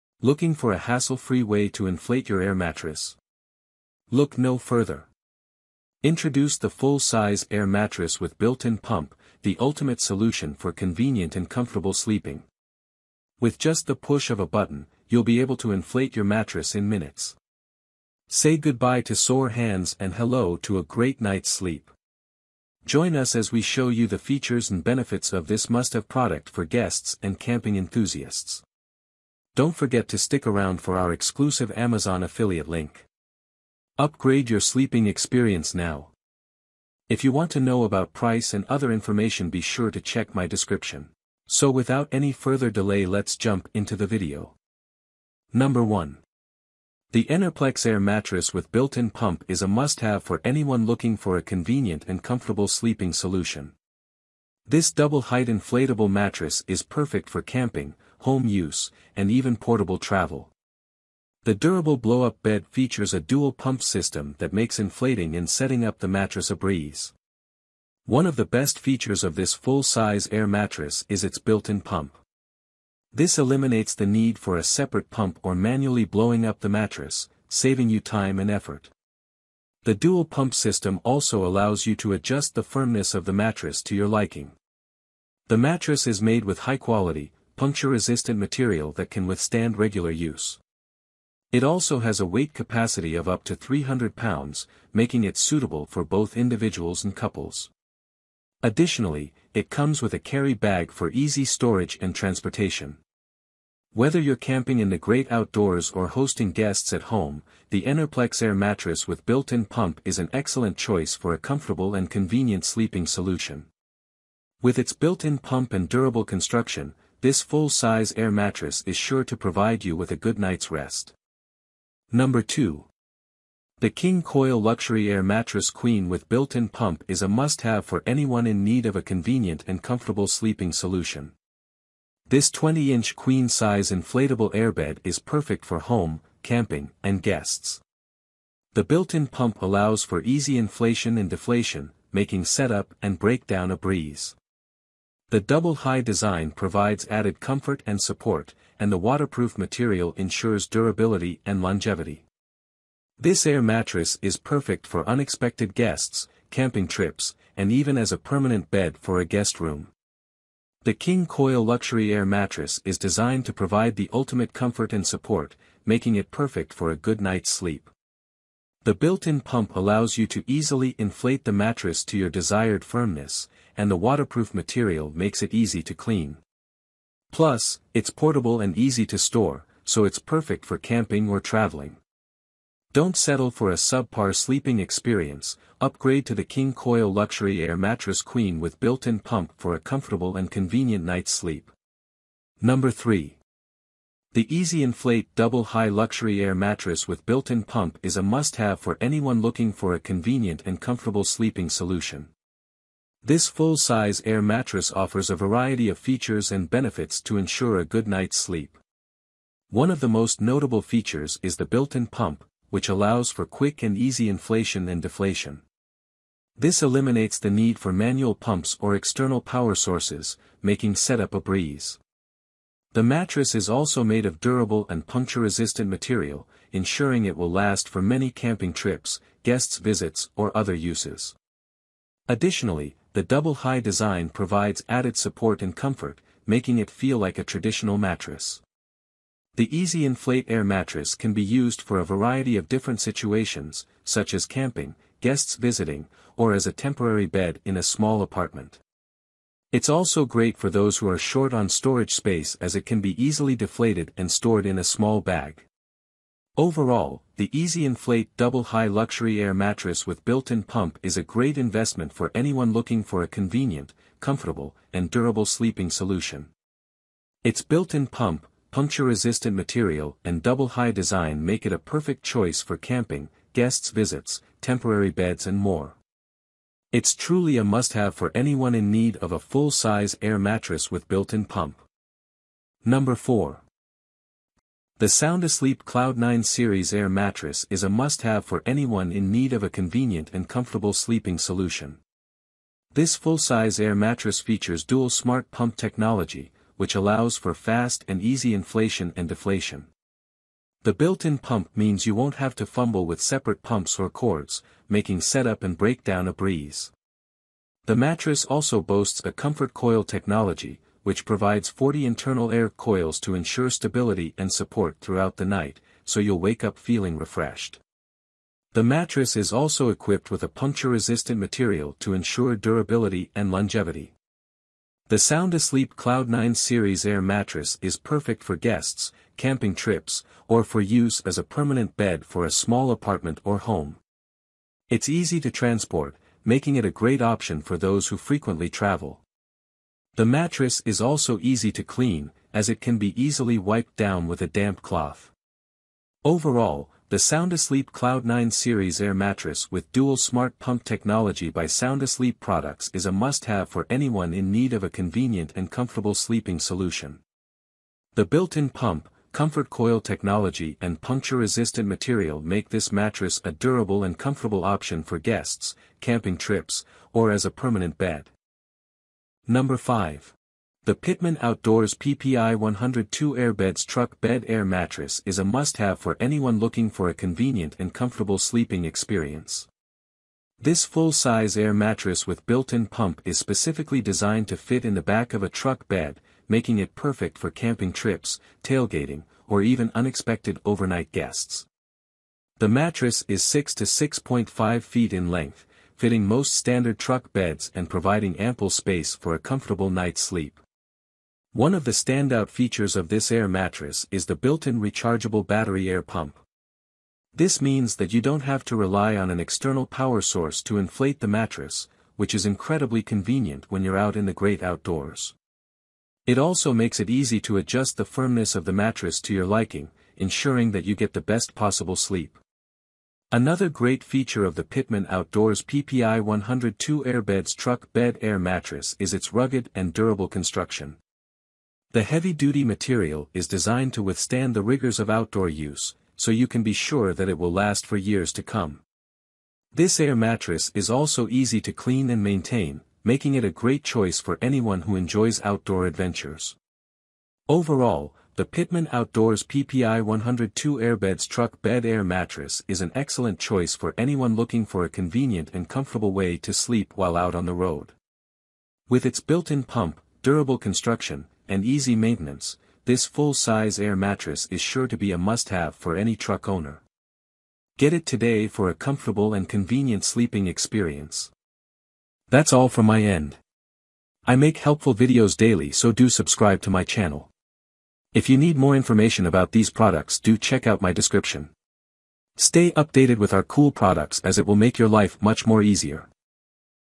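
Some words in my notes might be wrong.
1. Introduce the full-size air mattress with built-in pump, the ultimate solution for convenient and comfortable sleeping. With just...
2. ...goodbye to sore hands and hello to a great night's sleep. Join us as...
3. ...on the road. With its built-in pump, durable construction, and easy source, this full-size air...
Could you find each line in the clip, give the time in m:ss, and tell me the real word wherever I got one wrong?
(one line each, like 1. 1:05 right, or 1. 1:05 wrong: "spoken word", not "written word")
1. 0:06 right
2. 0:18 right
3. 7:37 wrong: "maintenance", not "source".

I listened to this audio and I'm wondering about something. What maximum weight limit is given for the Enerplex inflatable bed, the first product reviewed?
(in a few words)
300 pounds.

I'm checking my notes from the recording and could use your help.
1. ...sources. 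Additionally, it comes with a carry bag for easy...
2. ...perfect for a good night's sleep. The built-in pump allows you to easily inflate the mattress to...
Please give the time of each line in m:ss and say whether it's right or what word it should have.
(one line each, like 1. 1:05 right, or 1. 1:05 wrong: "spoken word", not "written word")
1. 1:37 wrong: "couples", not "sources"
2. 2:46 right.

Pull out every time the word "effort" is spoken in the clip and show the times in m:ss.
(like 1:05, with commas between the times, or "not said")
1:18.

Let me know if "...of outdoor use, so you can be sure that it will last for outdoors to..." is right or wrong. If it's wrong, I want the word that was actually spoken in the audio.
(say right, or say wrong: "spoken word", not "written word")
wrong: "years", not "outdoors".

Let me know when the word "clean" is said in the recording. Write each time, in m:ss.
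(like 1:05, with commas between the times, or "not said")
2:55, 5:41, 7:21.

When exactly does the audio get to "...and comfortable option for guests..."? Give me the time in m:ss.
6:04.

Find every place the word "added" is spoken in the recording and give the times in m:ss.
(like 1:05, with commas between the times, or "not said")
2:27, 3:54.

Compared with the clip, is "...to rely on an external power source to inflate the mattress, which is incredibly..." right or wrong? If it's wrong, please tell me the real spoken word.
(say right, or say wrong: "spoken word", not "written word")
right.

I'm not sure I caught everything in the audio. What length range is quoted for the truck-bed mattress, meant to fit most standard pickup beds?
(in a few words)
6 to 6.5 feet.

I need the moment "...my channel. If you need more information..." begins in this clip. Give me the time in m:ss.
7:56.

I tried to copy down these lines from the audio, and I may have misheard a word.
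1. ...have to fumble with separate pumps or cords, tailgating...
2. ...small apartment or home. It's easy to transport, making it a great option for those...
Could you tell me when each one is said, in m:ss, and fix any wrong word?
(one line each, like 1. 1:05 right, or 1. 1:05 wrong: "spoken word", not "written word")
1. 5:02 wrong: "making", not "tailgating"
2. 5:32 right.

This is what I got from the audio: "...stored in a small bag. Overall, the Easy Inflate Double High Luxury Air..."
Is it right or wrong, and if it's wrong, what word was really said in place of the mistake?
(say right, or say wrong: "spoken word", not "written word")
right.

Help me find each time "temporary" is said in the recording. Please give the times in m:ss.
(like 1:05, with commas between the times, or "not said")
4:06, 4:34.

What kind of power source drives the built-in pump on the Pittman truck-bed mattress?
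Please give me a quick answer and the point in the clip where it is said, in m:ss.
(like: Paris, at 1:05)
rechargeable battery, at 6:44.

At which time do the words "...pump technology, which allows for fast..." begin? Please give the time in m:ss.
4:55.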